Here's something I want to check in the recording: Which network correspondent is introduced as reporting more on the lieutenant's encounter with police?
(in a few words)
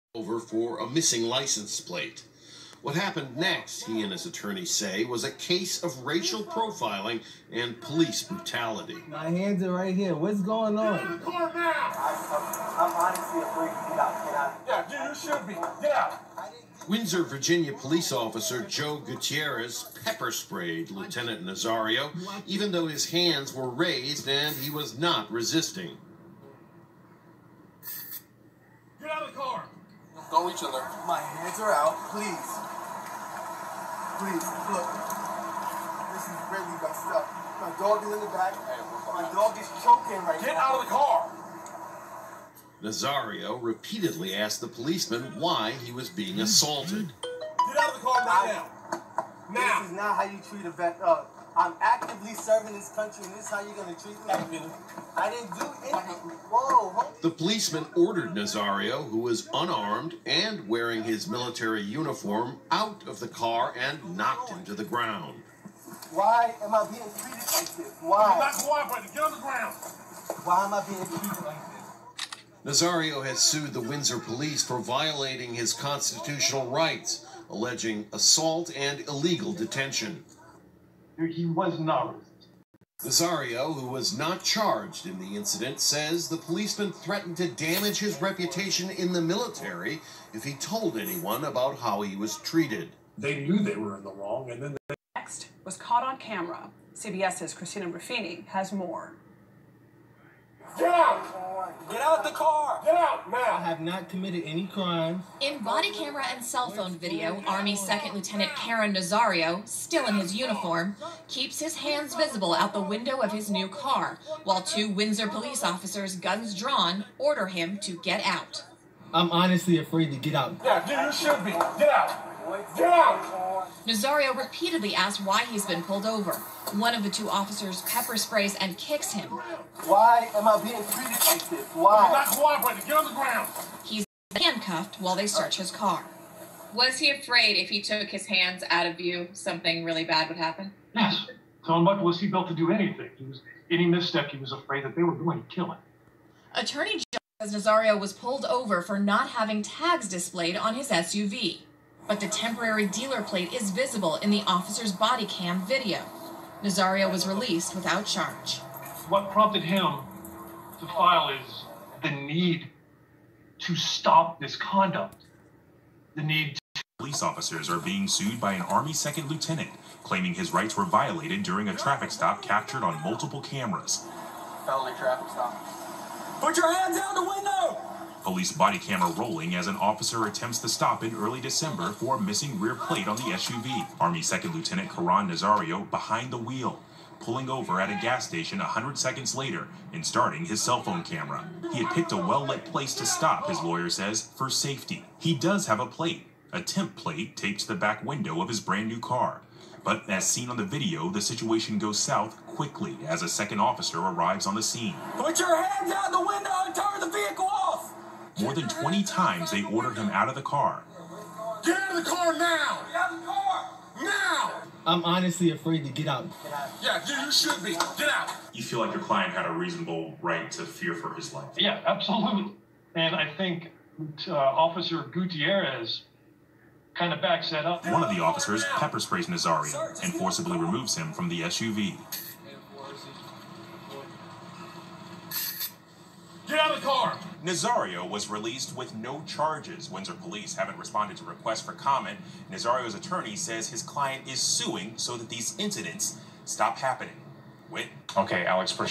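Christina Ruffini.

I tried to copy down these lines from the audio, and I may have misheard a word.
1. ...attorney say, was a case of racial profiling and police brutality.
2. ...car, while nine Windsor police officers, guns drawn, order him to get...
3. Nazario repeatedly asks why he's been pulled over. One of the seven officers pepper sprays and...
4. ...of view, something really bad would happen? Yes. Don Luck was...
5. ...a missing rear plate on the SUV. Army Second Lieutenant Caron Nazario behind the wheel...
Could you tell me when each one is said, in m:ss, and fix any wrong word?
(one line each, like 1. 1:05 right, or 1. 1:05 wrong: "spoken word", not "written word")
1. 0:04 right
2. 1:53 wrong: "two", not "nine"
3. 2:03 wrong: "two", not "seven"
4. 2:18 right
5. 3:02 right.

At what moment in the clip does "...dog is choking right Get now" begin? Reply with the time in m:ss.
0:39.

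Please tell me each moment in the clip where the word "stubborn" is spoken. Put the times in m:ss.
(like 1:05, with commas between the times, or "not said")
not said.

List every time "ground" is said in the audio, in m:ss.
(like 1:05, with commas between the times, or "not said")
1:04, 1:09, 2:13.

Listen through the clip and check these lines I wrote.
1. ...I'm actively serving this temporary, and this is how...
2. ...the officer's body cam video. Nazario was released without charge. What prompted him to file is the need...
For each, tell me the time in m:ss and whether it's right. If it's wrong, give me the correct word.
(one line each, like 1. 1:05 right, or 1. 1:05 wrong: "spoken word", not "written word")
1. 0:51 wrong: "country", not "temporary"
2. 2:34 right.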